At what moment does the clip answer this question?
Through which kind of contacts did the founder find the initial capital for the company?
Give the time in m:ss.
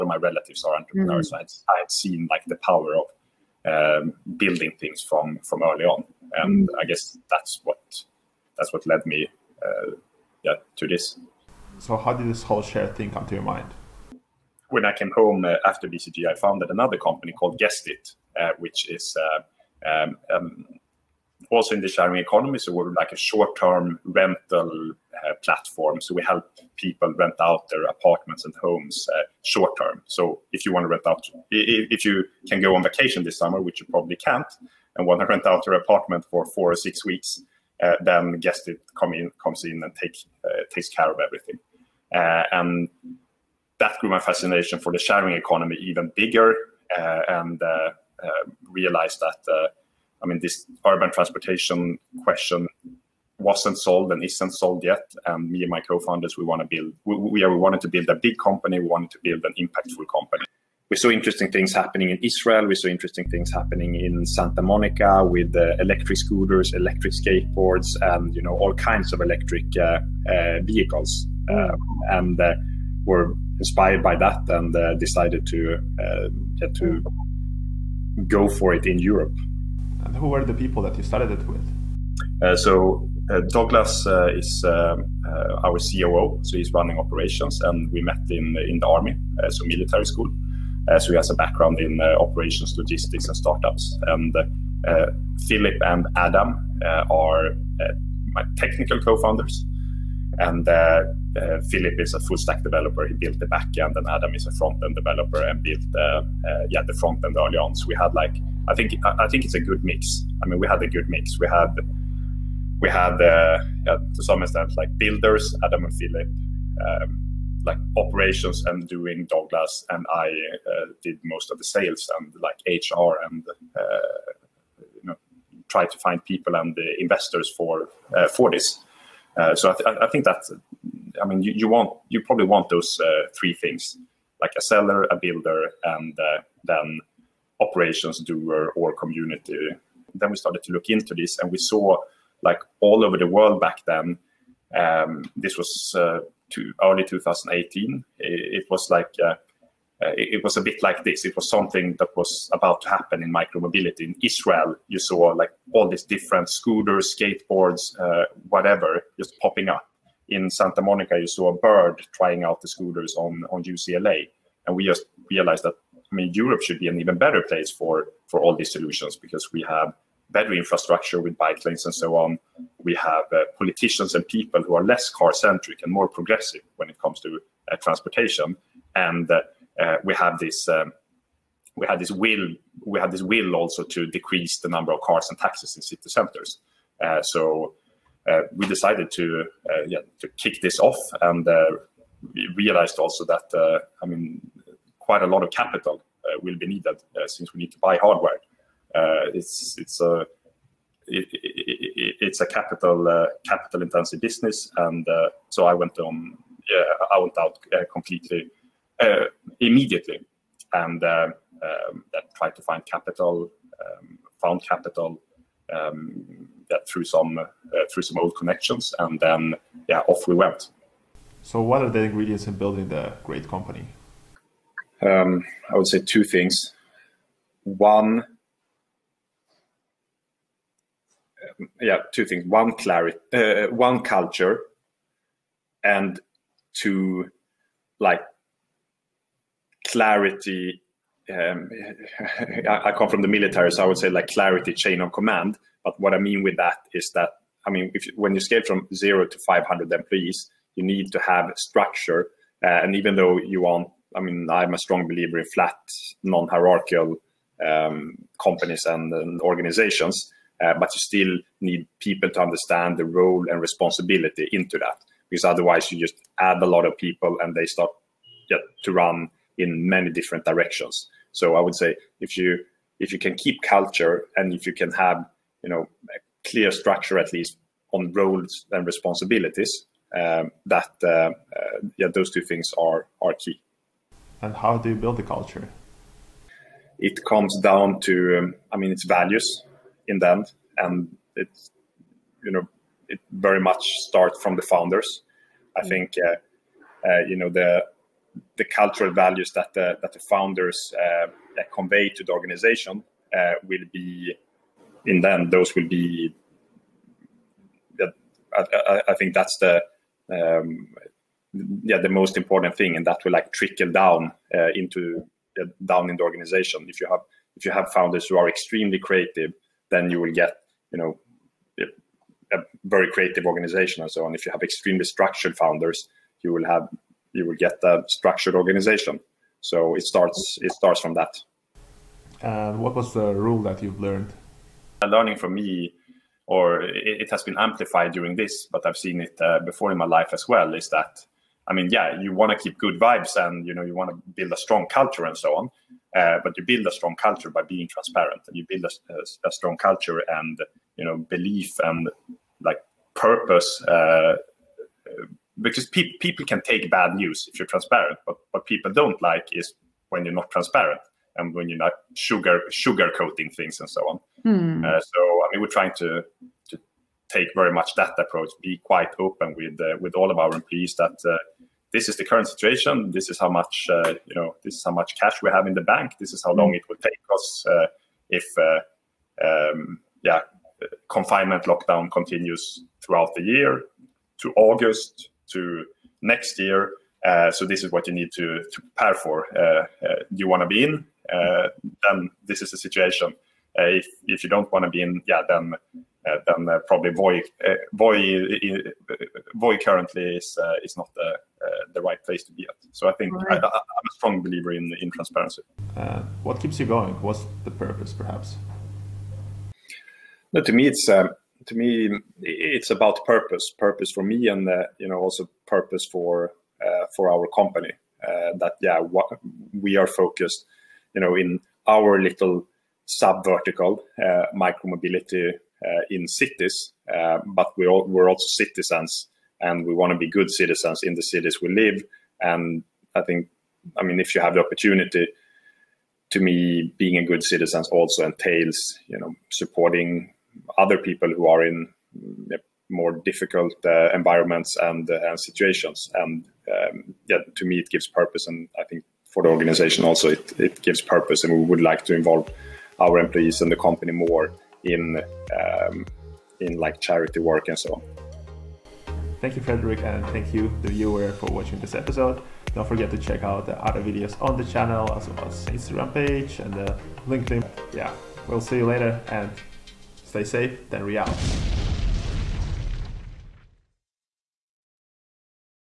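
3:38.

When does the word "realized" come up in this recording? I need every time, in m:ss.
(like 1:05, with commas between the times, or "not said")
0:48, 2:45, 3:12.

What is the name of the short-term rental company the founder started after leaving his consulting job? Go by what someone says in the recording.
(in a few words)
Guestit.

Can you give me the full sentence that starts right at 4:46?
It comes down to um, I mean it's values in them, and it's you know it very much starts from the founders.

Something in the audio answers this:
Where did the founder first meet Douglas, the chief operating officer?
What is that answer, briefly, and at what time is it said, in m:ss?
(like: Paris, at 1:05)
military school, at 1:29.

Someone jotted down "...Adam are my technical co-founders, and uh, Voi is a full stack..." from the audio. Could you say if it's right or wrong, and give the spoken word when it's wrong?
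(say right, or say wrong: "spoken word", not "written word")
wrong: "Philip", not "Voi".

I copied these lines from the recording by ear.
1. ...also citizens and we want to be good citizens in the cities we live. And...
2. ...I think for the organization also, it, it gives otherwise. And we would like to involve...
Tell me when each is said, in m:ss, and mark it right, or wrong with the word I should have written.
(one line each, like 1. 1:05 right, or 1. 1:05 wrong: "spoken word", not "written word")
1. 7:08 right
2. 7:28 wrong: "purpose", not "otherwise".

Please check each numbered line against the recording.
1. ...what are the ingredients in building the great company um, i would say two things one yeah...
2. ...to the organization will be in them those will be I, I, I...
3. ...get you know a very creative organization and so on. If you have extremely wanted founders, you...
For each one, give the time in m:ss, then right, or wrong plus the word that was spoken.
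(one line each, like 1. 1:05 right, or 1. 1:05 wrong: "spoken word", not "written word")
1. 3:41 right
2. 5:02 right
3. 5:20 wrong: "structured", not "wanted".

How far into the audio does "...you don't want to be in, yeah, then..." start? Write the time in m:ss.
6:34.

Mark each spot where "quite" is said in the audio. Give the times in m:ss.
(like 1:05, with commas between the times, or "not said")
3:14, 6:08.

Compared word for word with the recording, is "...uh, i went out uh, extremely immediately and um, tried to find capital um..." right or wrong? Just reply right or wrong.
wrong.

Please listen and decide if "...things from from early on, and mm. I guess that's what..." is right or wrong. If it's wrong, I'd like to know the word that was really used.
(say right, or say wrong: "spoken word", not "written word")
right.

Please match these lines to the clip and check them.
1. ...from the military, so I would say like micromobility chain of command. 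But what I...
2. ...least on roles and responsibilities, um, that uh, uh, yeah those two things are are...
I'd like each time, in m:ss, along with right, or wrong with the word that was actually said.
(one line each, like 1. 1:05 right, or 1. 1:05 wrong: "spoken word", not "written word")
1. 4:03 wrong: "clarity", not "micromobility"
2. 4:37 right.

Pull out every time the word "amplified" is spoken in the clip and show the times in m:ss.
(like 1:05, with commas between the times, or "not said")
5:37.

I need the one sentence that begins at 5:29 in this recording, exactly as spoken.
So it starts it starts from that.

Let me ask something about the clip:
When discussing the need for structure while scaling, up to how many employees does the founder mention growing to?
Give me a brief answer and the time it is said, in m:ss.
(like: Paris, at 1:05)
500, at 4:09.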